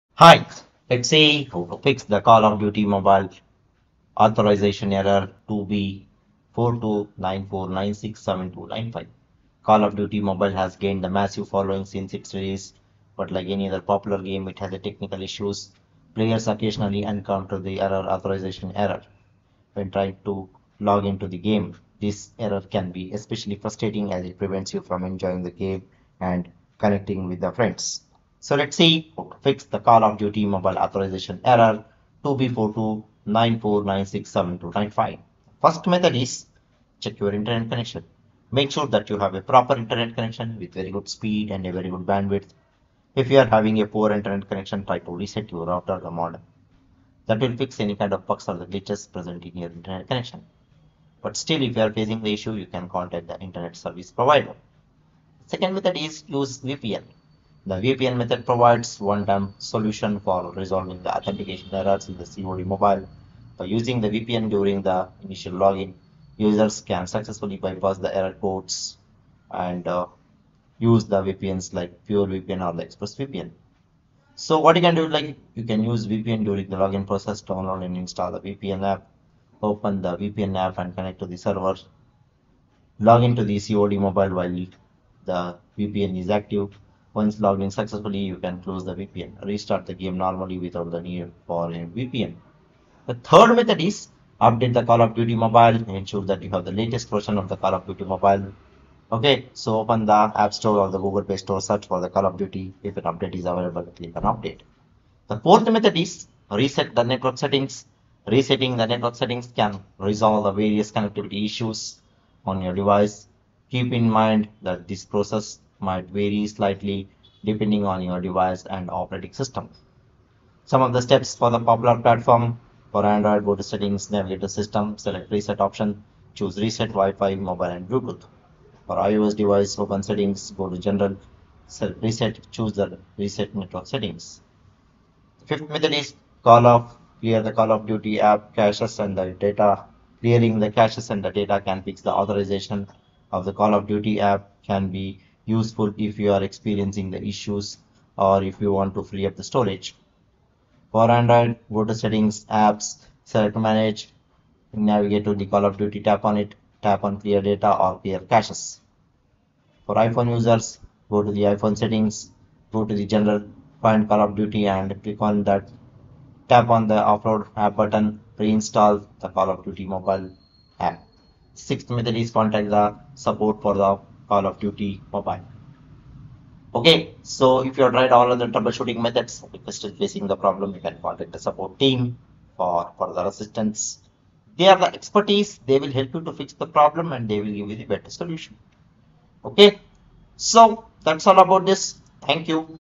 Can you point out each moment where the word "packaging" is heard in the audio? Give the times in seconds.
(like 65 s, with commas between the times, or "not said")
not said.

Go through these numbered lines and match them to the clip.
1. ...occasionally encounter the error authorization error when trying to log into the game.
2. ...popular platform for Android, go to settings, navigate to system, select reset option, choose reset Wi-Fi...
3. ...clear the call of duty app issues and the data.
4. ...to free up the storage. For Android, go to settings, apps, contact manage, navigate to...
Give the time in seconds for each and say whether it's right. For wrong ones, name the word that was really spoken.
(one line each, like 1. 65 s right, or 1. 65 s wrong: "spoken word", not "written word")
1. 16 s right
2. 121 s right
3. 137 s wrong: "caches", not "issues"
4. 148 s wrong: "select", not "contact".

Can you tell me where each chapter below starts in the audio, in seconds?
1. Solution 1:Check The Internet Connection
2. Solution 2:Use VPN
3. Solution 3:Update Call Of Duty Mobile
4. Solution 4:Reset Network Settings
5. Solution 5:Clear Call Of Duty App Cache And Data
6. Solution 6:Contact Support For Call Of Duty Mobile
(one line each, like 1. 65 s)
1. 38 s
2. 57 s
3. 95 s
4. 109 s
5. 135 s
6. 172 s.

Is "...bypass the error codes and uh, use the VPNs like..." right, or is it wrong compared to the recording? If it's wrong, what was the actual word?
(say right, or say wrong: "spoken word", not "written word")
right.